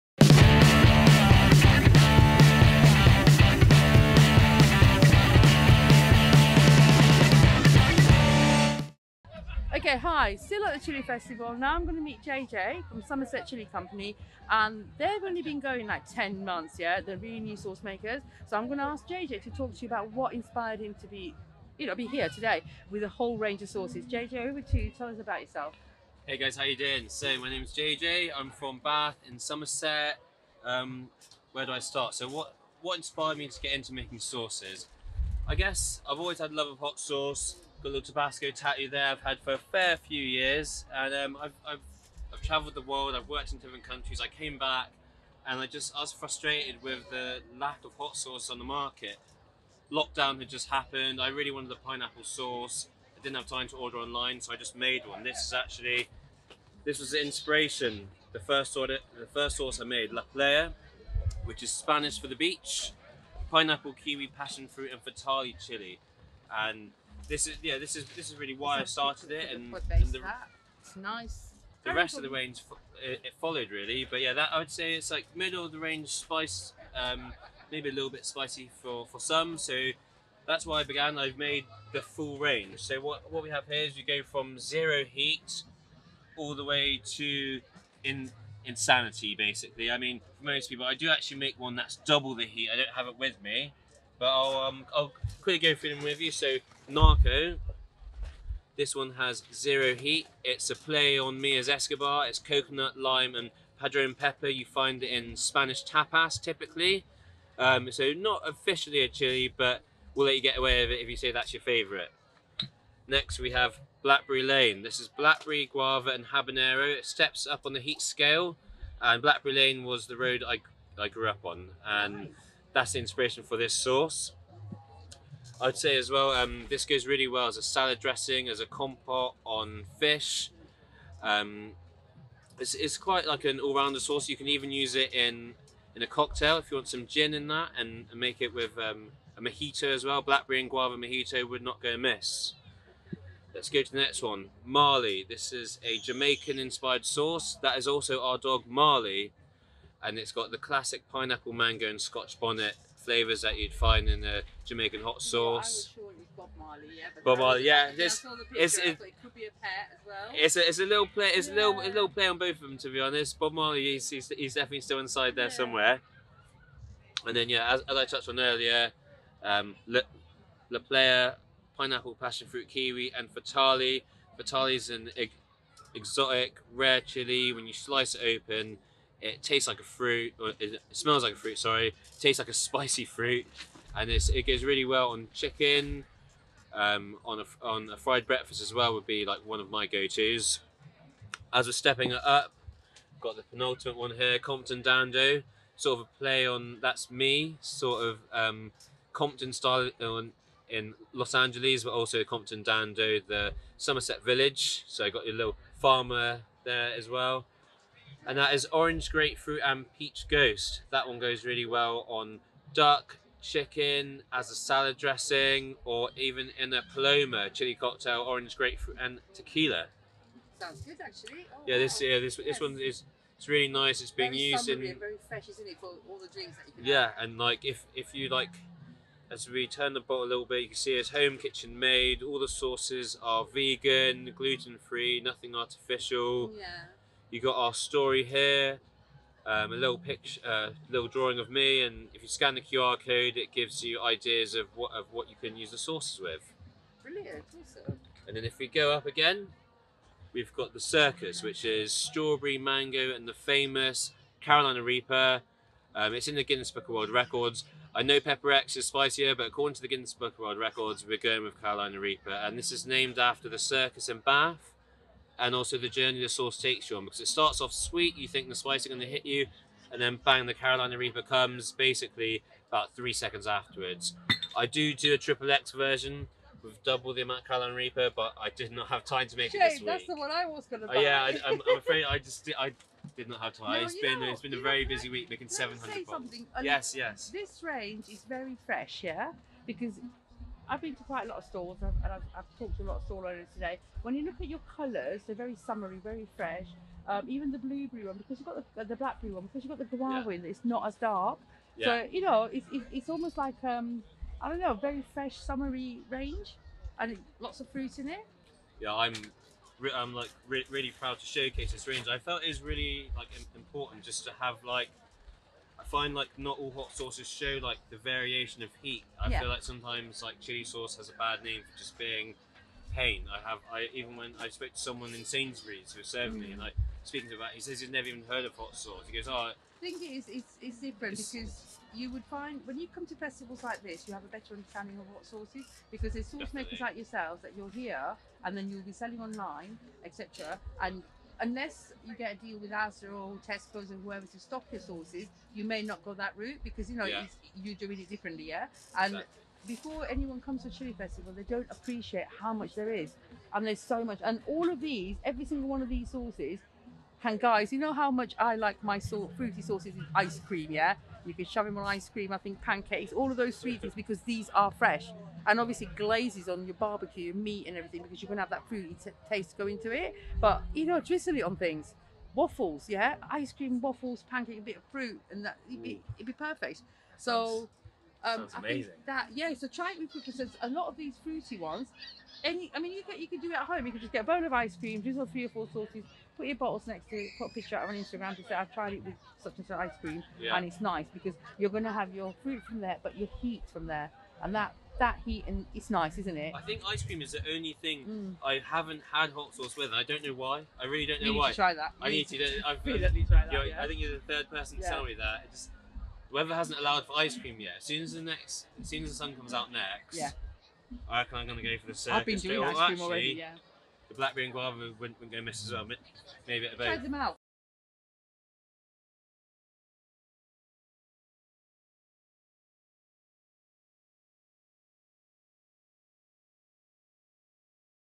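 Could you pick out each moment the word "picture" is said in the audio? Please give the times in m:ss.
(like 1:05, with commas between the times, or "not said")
3:59, 6:27.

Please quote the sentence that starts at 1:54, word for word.
This is blackberry, guava, and habanero.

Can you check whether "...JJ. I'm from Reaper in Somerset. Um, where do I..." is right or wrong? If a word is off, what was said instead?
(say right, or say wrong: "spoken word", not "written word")
wrong: "Bath", not "Reaper".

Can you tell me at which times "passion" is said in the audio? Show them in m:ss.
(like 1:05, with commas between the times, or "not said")
1:04, 2:52.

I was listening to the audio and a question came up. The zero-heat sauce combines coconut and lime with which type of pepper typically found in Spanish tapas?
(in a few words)
padron pepper.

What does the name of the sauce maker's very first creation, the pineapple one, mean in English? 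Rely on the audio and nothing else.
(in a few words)
the beach.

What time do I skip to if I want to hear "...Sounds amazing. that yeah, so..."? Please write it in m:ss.
6:18.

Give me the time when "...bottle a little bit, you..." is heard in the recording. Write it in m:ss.
3:50.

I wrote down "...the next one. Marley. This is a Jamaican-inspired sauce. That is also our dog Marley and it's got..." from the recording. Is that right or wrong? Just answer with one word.
right.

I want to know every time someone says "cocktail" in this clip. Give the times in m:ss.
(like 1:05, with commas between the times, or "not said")
2:16, 3:37.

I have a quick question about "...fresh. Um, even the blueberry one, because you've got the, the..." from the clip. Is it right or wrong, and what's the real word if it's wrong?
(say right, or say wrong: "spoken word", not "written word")
right.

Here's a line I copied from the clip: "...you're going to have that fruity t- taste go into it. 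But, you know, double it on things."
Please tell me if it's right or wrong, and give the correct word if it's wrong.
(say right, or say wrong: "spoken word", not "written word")
wrong: "drizzle", not "double".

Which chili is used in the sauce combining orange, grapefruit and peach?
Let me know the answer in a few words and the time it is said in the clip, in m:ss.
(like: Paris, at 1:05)
ghost, at 3:29.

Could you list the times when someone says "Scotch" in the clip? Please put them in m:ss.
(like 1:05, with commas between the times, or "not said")
2:32.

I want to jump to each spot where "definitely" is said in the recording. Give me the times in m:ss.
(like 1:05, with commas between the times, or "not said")
2:44, 5:36.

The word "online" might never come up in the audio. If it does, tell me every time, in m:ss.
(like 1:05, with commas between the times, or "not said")
0:53, 5:39.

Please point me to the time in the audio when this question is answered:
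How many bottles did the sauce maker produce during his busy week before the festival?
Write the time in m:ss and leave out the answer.
4:45.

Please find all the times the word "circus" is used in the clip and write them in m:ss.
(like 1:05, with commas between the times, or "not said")
4:10, 4:23, 6:51.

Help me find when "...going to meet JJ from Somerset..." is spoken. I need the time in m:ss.
0:11.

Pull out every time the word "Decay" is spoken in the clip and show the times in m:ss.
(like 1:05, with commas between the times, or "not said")
not said.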